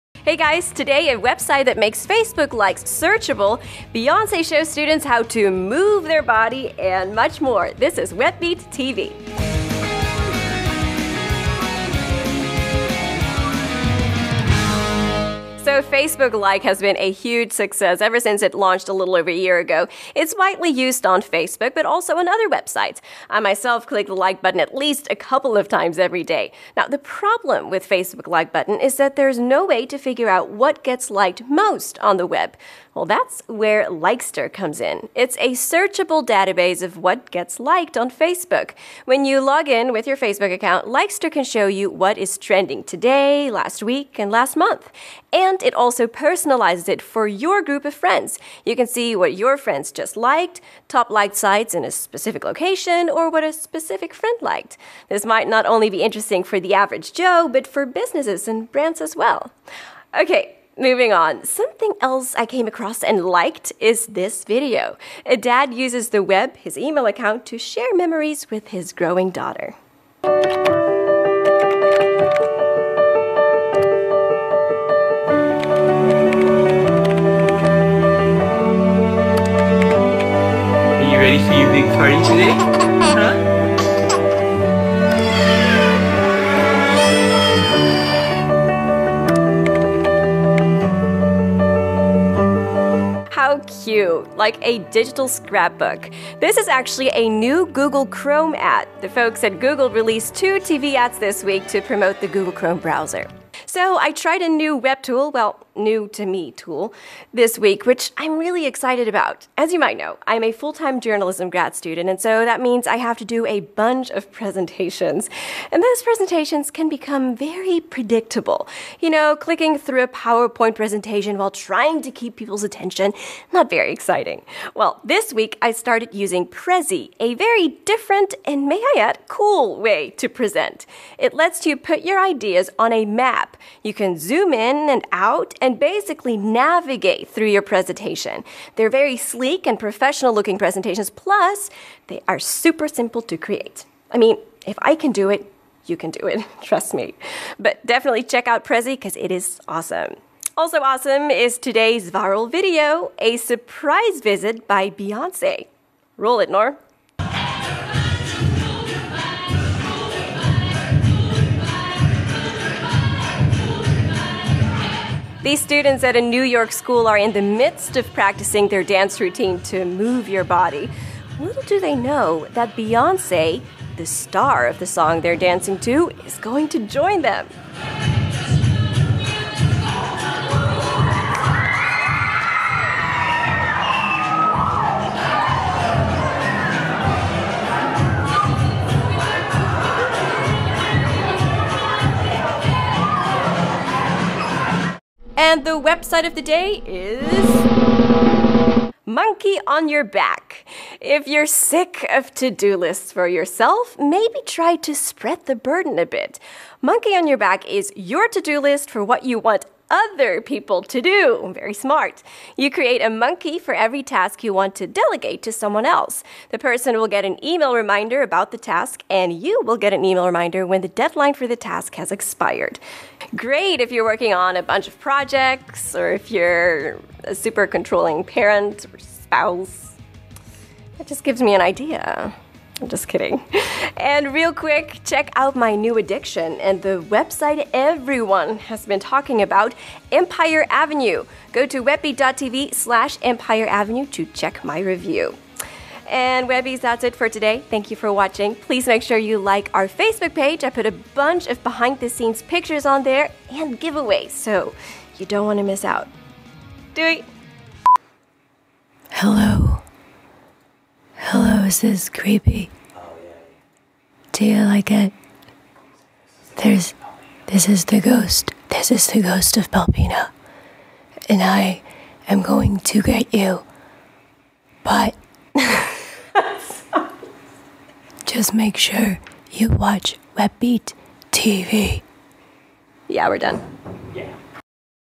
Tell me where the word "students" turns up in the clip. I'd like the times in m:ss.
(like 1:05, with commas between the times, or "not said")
0:04, 1:51, 2:45.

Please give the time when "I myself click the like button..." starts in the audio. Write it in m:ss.
0:23.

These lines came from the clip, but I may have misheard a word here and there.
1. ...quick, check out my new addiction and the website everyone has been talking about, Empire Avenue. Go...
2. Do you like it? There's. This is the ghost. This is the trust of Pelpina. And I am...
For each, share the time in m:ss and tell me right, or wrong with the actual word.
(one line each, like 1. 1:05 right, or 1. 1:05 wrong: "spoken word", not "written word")
1. 3:54 right
2. 4:24 wrong: "ghost", not "trust".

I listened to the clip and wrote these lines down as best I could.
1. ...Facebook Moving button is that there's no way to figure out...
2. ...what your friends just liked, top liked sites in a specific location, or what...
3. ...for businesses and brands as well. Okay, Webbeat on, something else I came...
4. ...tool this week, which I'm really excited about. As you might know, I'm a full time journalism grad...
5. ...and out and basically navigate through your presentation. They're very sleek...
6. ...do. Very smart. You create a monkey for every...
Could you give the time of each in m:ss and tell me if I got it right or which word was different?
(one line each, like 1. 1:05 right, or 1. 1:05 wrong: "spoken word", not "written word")
1. 0:27 wrong: "Like", not "Moving"
2. 0:49 right
3. 0:57 wrong: "Moving", not "Webbeat"
4. 1:46 right
5. 2:14 right
6. 3:31 right.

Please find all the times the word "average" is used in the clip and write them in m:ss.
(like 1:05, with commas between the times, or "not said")
0:56.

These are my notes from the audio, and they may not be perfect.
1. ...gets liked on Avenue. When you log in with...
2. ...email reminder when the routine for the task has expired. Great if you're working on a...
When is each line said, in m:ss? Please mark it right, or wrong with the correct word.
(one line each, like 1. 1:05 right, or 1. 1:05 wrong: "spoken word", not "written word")
1. 0:37 wrong: "Facebook", not "Avenue"
2. 3:40 wrong: "deadline", not "routine".